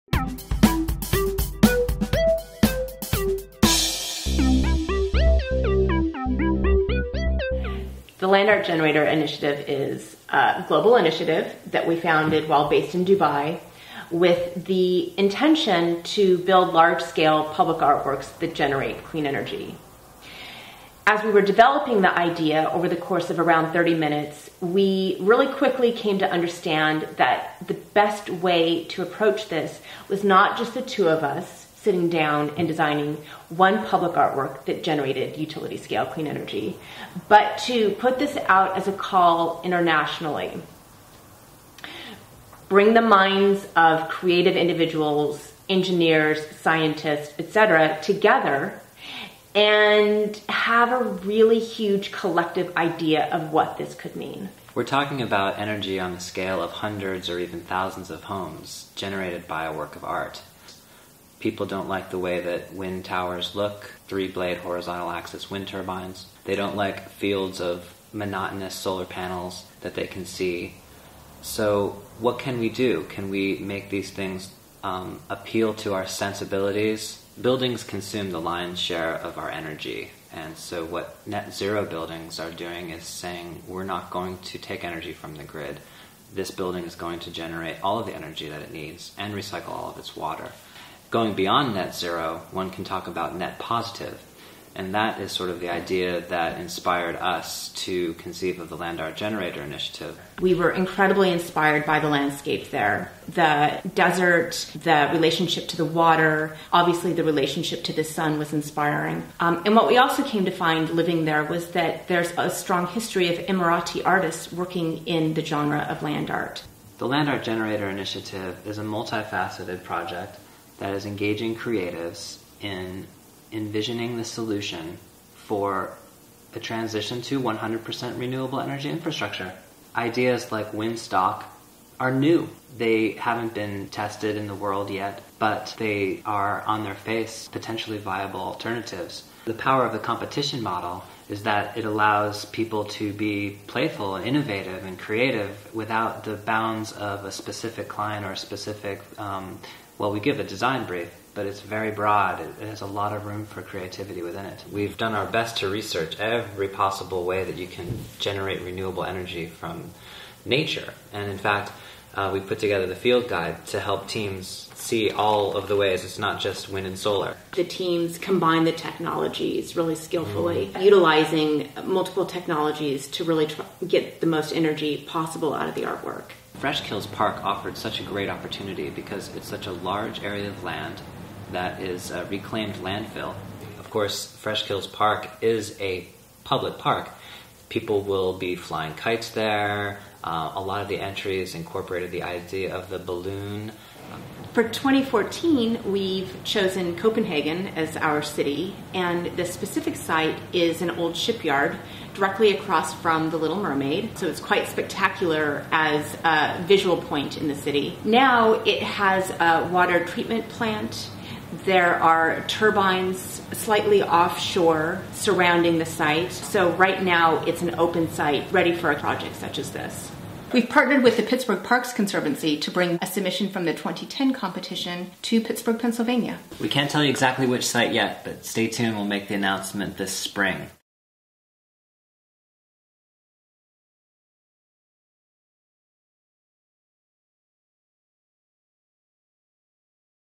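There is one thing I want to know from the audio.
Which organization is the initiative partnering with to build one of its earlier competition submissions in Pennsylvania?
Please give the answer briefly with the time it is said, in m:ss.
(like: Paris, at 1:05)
Pittsburgh Parks Conservancy, at 3:41.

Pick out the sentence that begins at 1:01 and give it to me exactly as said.
People don't like the way that wind towers look, three blade horizontal axis wind turbines.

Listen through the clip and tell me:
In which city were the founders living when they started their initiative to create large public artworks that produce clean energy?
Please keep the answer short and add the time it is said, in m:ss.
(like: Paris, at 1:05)
Dubai, at 0:13.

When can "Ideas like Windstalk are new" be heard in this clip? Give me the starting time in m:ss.
2:09.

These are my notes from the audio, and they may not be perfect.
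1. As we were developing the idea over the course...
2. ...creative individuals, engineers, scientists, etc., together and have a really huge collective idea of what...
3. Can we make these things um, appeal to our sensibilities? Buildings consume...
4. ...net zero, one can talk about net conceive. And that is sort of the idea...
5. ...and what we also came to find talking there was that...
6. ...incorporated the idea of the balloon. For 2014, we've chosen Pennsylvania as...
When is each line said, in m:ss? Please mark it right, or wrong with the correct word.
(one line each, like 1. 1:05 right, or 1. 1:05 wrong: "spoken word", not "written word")
1. 0:21 right
2. 0:44 right
3. 1:13 right
4. 1:31 wrong: "positive", not "conceive"
5. 1:49 wrong: "living", not "talking"
6. 3:11 wrong: "Copenhagen", not "Pennsylvania".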